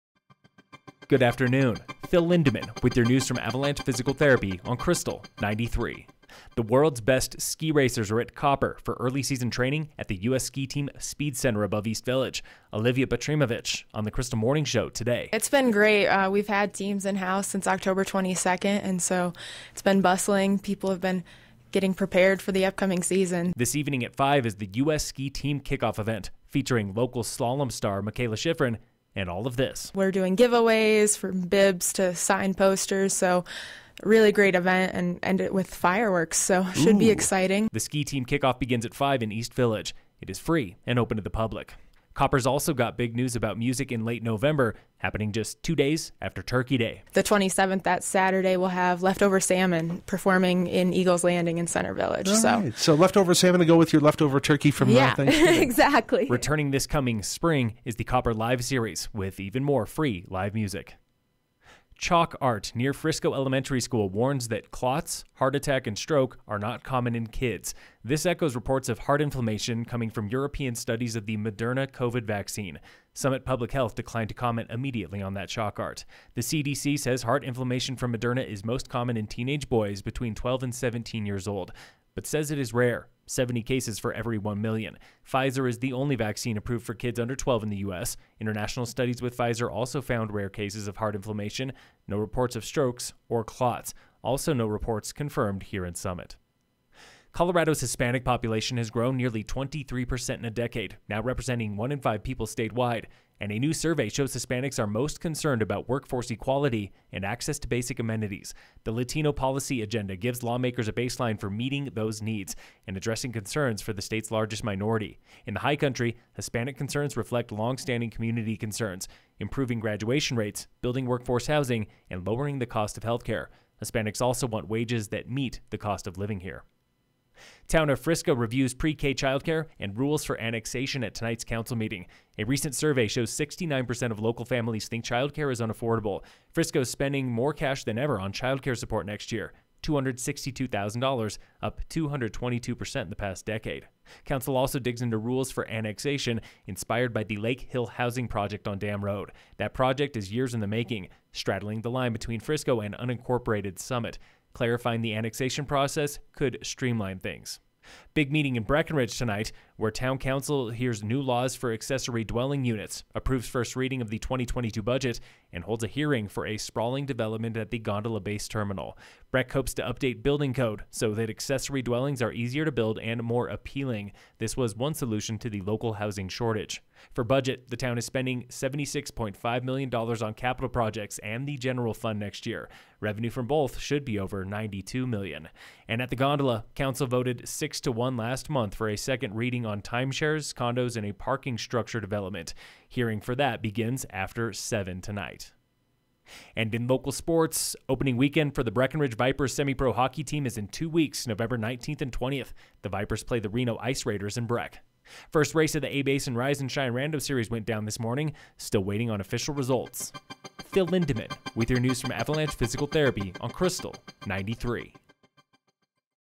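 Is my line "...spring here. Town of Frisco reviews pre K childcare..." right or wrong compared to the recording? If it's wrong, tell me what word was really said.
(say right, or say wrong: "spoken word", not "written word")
wrong: "living", not "spring".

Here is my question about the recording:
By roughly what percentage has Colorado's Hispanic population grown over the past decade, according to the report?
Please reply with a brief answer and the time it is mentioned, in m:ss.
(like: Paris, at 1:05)
23%, at 1:39.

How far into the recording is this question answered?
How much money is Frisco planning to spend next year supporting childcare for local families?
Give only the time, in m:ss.
2:19.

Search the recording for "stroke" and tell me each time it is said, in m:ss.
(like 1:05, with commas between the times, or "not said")
1:05, 1:32.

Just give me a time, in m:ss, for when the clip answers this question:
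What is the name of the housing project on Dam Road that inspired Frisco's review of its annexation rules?
2:27.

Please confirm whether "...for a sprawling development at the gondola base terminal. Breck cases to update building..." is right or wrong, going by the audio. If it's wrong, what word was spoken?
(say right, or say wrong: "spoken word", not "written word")
wrong: "hopes", not "cases".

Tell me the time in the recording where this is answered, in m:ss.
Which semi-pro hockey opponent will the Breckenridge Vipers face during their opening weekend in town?
3:23.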